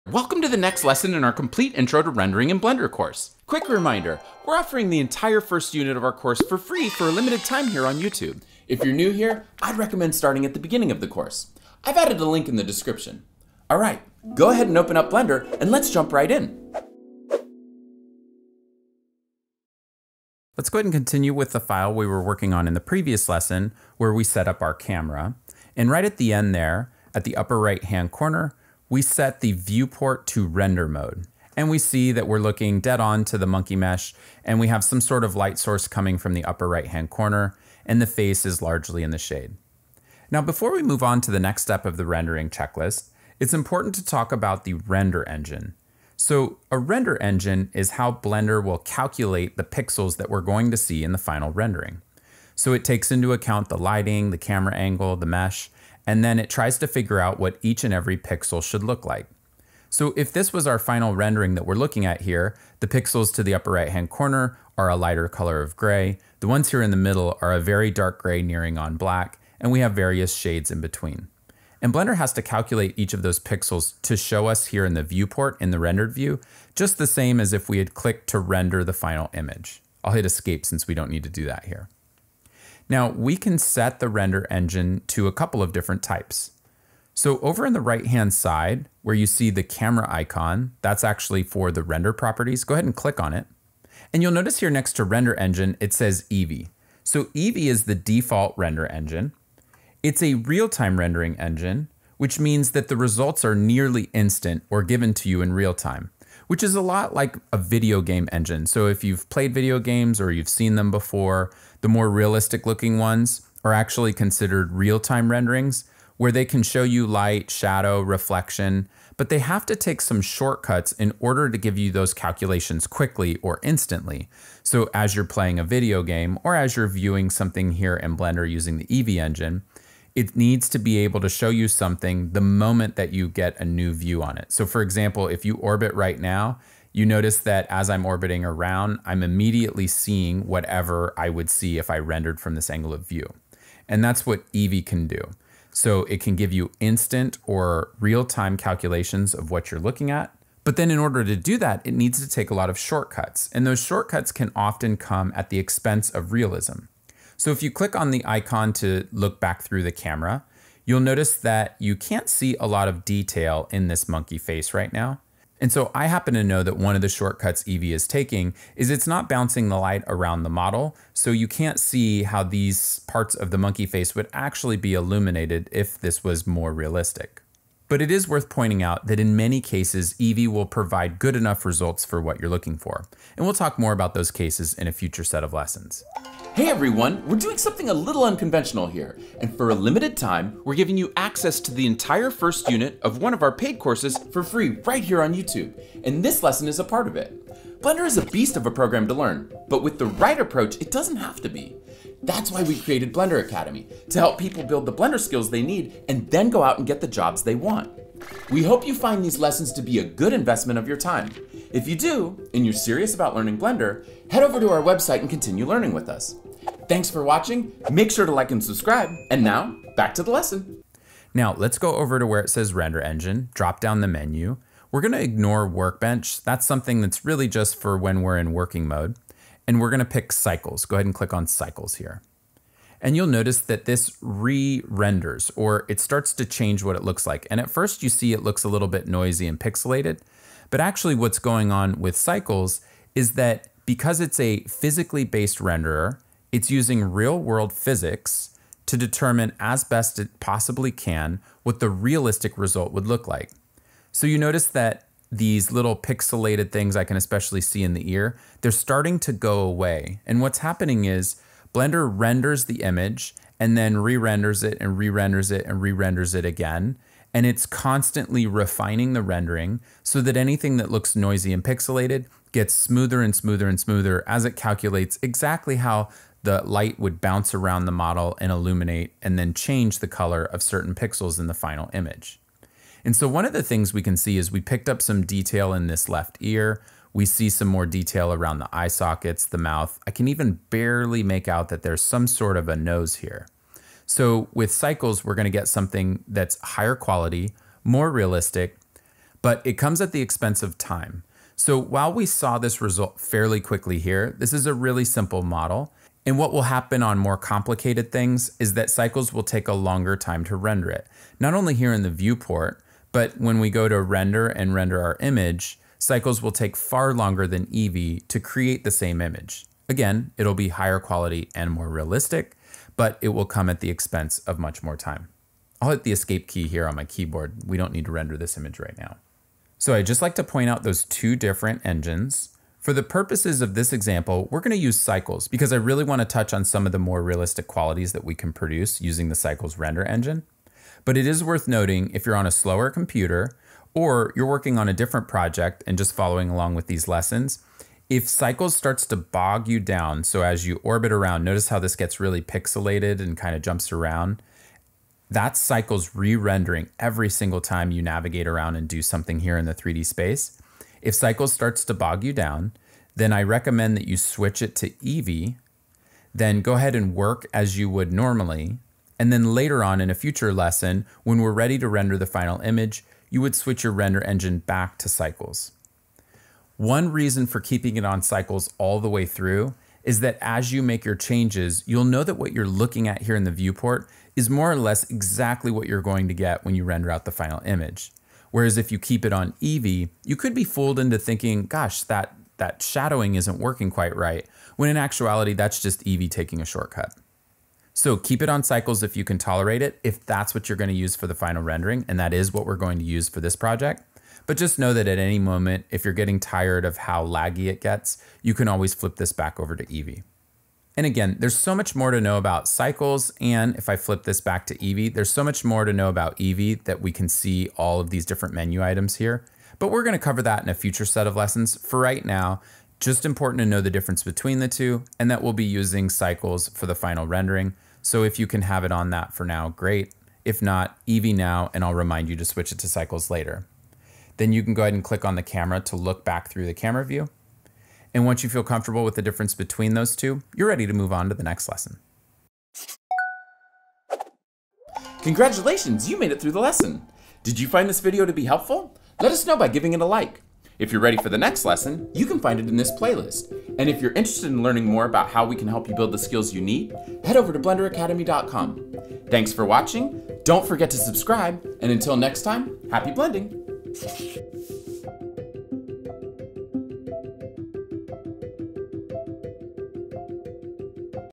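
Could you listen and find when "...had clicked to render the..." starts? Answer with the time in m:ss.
1:17.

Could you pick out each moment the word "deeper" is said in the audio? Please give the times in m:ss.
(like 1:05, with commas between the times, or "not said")
not said.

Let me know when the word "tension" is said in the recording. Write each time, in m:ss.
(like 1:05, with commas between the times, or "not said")
not said.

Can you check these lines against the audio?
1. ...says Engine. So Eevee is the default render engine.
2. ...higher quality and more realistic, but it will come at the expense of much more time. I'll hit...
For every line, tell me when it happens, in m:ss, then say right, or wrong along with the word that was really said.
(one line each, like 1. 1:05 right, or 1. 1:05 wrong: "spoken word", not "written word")
1. 1:35 wrong: "Eevee", not "Engine"
2. 5:20 right.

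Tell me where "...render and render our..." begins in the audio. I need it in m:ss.
5:14.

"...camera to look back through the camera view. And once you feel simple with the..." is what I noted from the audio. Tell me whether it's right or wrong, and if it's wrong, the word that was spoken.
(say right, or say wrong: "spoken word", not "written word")
wrong: "comfortable", not "simple".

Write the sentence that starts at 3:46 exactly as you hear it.
That's something that's really just for when we're in working mode.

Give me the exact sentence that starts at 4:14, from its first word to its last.
So you notice that these little pixelated things I can especially see in the ear, they're starting to go away.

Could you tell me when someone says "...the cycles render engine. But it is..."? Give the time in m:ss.
5:39.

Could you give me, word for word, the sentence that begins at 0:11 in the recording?
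I've added a link in the description.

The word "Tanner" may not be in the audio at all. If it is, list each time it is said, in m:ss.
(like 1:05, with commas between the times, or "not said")
not said.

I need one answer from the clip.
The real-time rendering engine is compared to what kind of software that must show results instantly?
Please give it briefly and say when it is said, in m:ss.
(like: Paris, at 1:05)
Video game engine, at 1:47.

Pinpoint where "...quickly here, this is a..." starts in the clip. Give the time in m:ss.
5:03.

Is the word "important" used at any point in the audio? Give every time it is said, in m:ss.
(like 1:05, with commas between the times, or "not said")
0:43, 7:03.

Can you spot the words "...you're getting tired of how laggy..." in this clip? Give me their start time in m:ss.
6:46.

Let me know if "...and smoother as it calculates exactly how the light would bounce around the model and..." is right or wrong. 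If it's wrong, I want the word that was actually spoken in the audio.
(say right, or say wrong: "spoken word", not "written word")
right.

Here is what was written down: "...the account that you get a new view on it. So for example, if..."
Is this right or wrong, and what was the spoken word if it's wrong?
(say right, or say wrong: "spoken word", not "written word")
wrong: "moment", not "account".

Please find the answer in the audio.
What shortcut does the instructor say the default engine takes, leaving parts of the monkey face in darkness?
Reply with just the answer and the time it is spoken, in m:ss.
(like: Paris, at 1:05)
Not bouncing the light, at 2:49.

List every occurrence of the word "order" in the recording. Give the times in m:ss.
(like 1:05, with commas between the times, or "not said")
2:01, 2:30.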